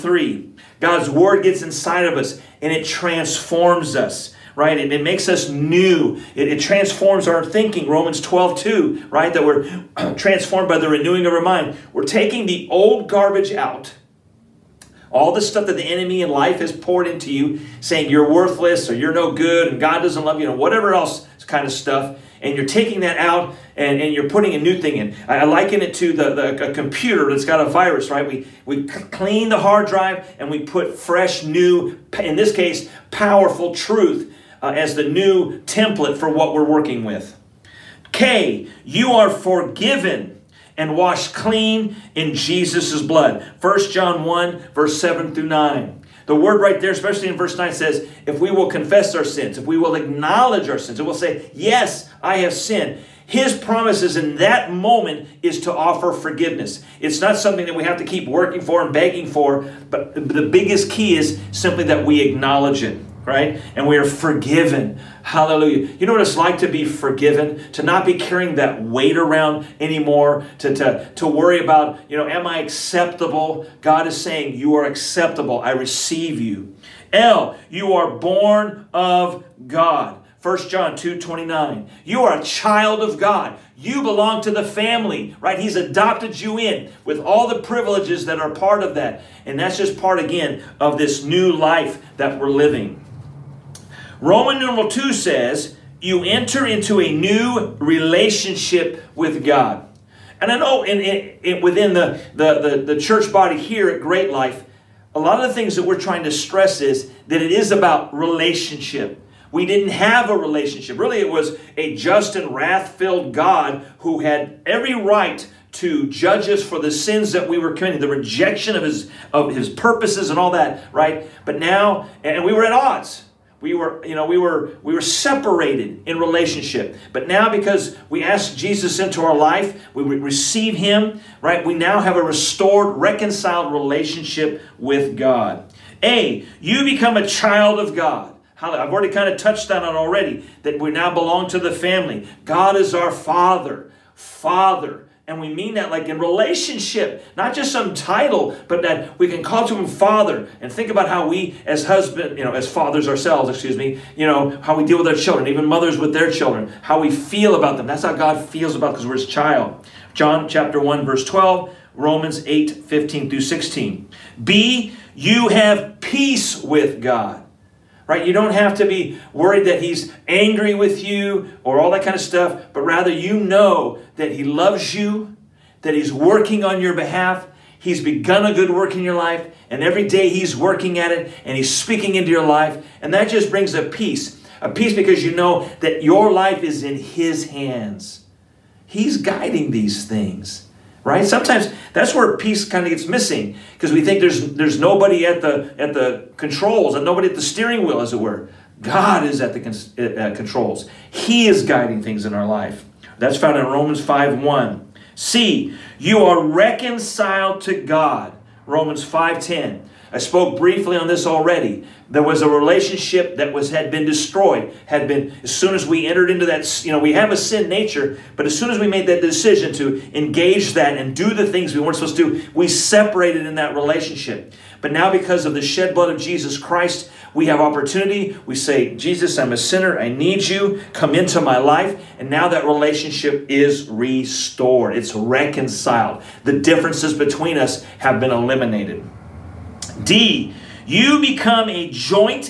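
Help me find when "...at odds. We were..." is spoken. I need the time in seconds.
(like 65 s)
122 s.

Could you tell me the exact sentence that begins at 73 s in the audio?
God is saying, you are acceptable.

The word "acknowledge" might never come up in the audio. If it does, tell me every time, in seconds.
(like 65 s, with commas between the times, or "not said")
49 s, 62 s.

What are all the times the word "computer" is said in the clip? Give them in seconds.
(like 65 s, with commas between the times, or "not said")
26 s.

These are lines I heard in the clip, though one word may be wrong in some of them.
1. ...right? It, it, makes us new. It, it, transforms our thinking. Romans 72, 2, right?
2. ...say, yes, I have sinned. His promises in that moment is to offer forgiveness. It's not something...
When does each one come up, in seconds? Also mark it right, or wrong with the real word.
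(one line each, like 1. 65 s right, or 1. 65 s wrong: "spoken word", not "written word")
1. 4 s wrong: "12", not "72"
2. 51 s right.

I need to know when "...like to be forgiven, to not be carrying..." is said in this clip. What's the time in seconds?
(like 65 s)
66 s.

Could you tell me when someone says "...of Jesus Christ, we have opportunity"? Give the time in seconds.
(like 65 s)
226 s.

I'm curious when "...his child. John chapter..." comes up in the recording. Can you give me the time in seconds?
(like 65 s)
159 s.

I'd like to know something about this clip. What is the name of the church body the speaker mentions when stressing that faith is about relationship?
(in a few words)
Great Life.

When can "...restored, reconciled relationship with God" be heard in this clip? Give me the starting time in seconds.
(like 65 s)
132 s.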